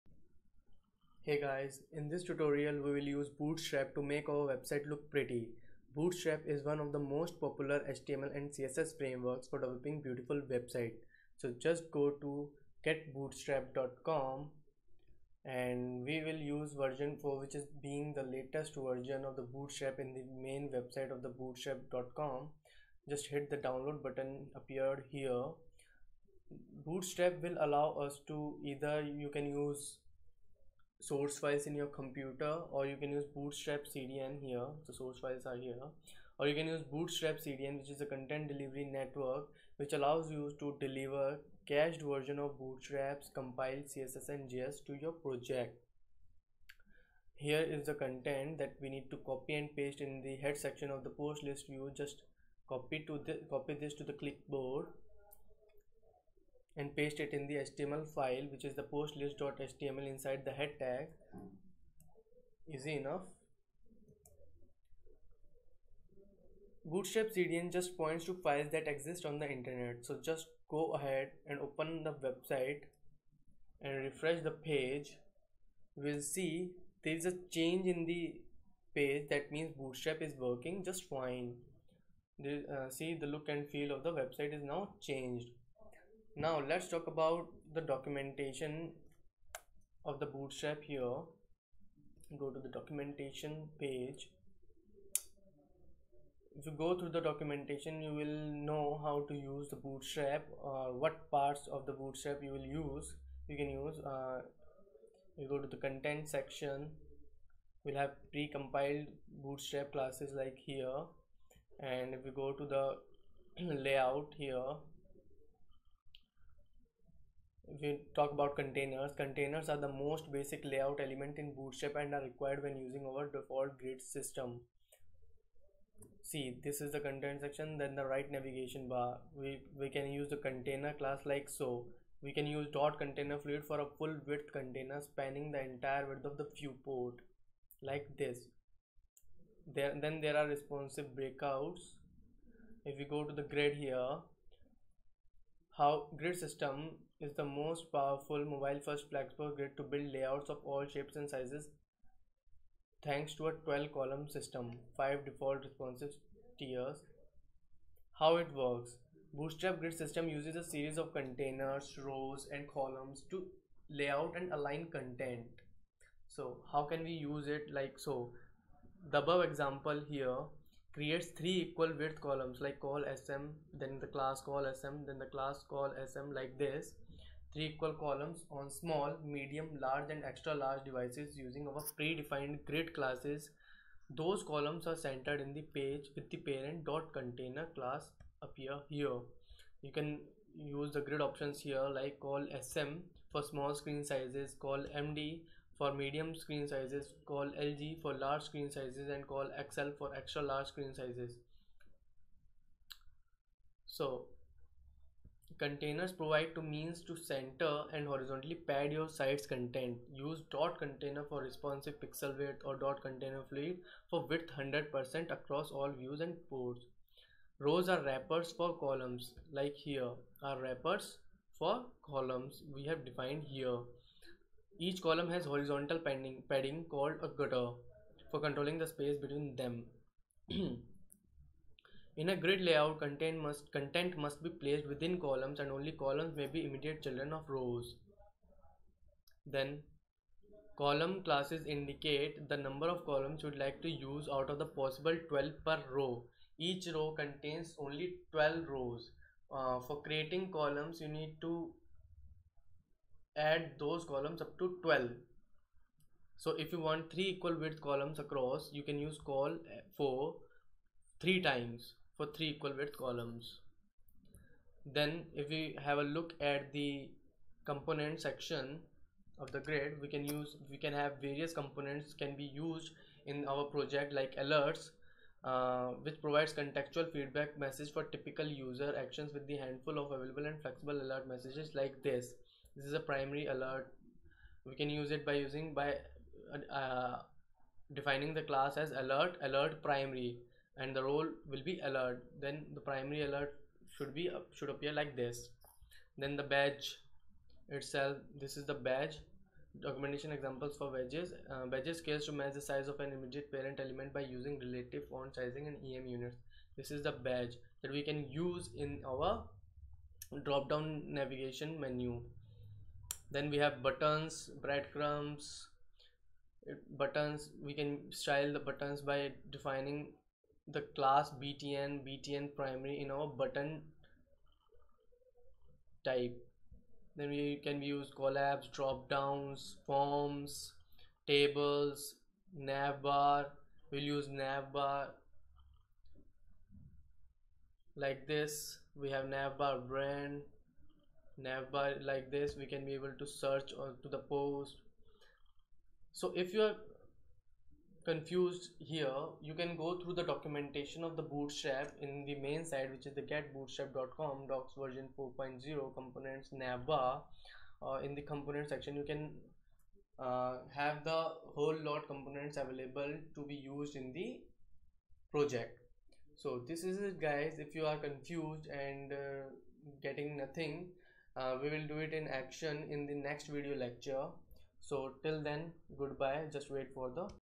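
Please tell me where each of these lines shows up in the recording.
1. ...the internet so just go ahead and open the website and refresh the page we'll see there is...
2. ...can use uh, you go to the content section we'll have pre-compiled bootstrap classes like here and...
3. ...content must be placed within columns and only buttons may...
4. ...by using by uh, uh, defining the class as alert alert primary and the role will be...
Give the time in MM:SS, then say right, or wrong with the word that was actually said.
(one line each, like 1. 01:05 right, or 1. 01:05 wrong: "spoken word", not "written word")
1. 01:09 right
2. 01:43 right
3. 03:53 wrong: "columns", not "buttons"
4. 04:45 right.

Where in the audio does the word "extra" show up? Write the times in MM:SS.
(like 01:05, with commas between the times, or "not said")
03:00, 03:20.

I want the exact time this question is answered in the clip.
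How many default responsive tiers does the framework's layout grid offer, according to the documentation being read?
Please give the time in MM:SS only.
02:34.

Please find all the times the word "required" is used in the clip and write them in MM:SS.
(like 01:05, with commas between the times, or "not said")
02:02.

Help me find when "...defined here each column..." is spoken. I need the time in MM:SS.
03:43.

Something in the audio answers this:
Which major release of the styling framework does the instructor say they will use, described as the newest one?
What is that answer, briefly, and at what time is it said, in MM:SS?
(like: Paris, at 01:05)
version 4, at 00:16.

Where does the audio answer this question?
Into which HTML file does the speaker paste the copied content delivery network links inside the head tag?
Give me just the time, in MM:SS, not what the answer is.
00:58.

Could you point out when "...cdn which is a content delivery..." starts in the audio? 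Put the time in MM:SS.
00:37.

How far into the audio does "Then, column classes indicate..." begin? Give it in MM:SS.
03:59.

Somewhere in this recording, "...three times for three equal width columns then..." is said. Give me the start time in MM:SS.
04:21.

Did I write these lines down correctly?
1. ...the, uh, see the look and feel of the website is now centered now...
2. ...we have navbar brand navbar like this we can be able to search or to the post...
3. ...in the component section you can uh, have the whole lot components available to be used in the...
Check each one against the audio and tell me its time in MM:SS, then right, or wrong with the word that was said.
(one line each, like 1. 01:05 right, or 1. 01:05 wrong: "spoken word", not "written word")
1. 01:22 wrong: "changed", not "centered"
2. 05:38 right
3. 05:58 right.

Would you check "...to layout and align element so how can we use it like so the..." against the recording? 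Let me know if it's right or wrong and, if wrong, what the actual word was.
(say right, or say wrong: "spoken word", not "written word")
wrong: "content", not "element".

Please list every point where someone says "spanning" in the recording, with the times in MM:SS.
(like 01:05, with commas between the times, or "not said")
02:15.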